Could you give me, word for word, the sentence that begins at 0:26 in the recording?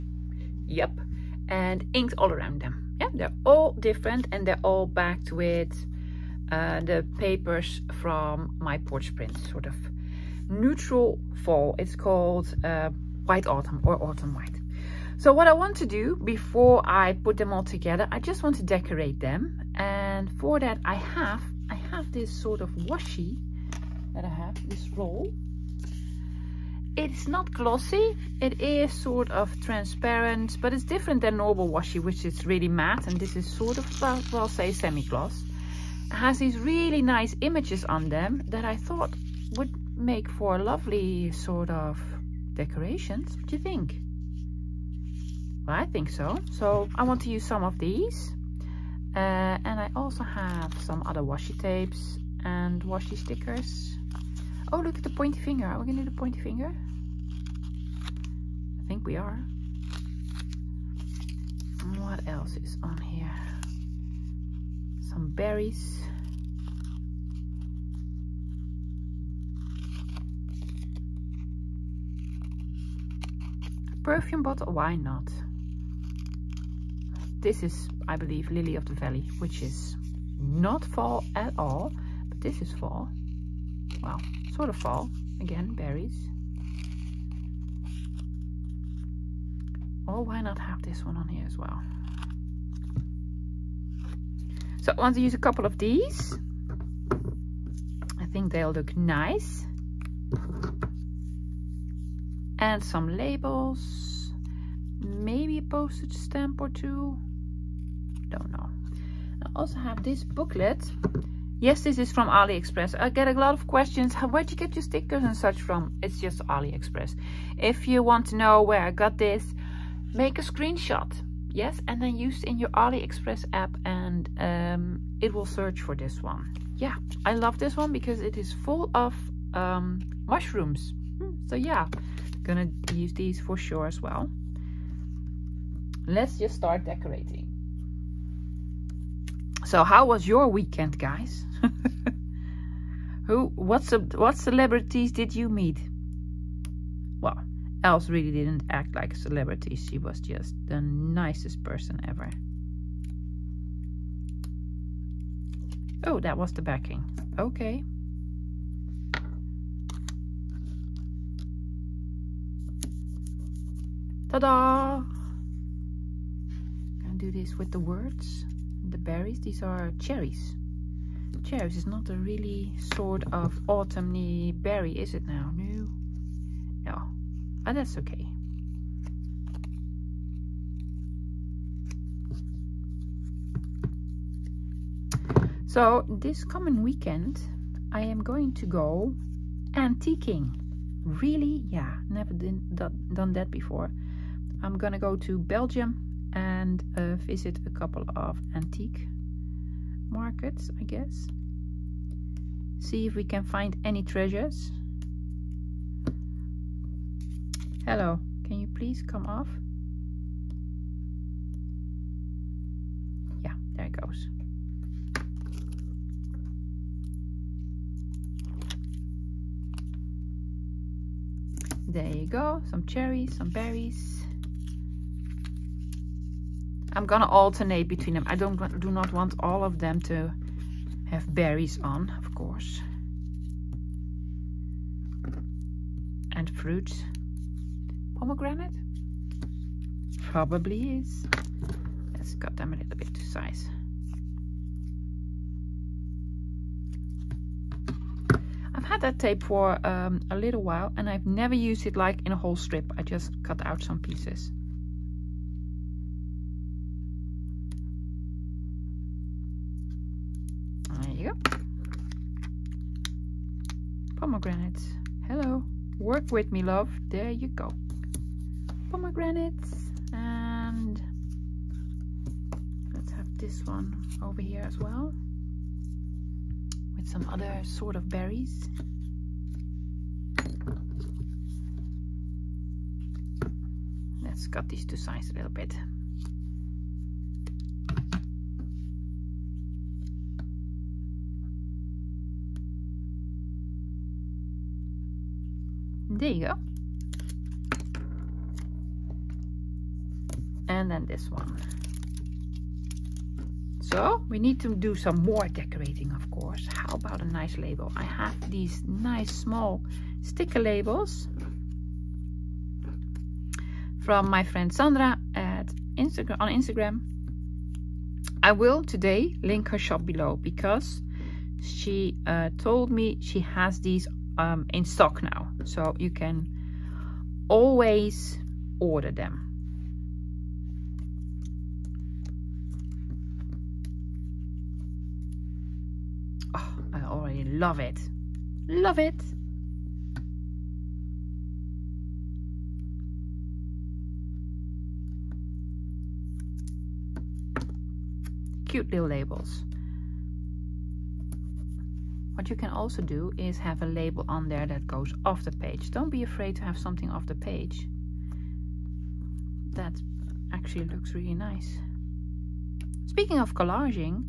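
It's not glossy, it is sort of transparent, but it's different than normal washi, which is really matte.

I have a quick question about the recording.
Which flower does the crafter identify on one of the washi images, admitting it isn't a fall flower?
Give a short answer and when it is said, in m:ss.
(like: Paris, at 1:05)
Lily of the Valley, at 1:18.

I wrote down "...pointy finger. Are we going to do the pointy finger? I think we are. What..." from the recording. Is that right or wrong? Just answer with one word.
right.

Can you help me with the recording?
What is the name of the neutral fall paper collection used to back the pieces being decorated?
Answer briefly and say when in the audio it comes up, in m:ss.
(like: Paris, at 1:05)
White Autumn, at 0:13.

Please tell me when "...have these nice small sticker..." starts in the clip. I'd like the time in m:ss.
5:08.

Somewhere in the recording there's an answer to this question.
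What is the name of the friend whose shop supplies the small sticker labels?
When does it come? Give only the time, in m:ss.
5:14.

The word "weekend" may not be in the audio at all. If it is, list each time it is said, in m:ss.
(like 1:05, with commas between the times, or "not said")
2:20, 3:06.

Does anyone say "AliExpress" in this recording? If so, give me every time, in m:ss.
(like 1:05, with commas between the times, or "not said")
1:52, 1:56, 2:02.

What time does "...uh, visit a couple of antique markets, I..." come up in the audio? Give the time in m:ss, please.
3:16.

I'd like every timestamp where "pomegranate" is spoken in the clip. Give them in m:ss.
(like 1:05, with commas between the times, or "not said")
3:58, 4:24, 4:28.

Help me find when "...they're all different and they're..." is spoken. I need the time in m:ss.
0:03.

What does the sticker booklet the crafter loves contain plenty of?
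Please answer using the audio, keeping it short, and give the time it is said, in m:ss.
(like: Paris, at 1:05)
mushrooms, at 2:10.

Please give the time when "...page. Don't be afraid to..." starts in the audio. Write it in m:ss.
5:55.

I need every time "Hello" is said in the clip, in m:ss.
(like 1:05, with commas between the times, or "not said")
3:27, 4:25.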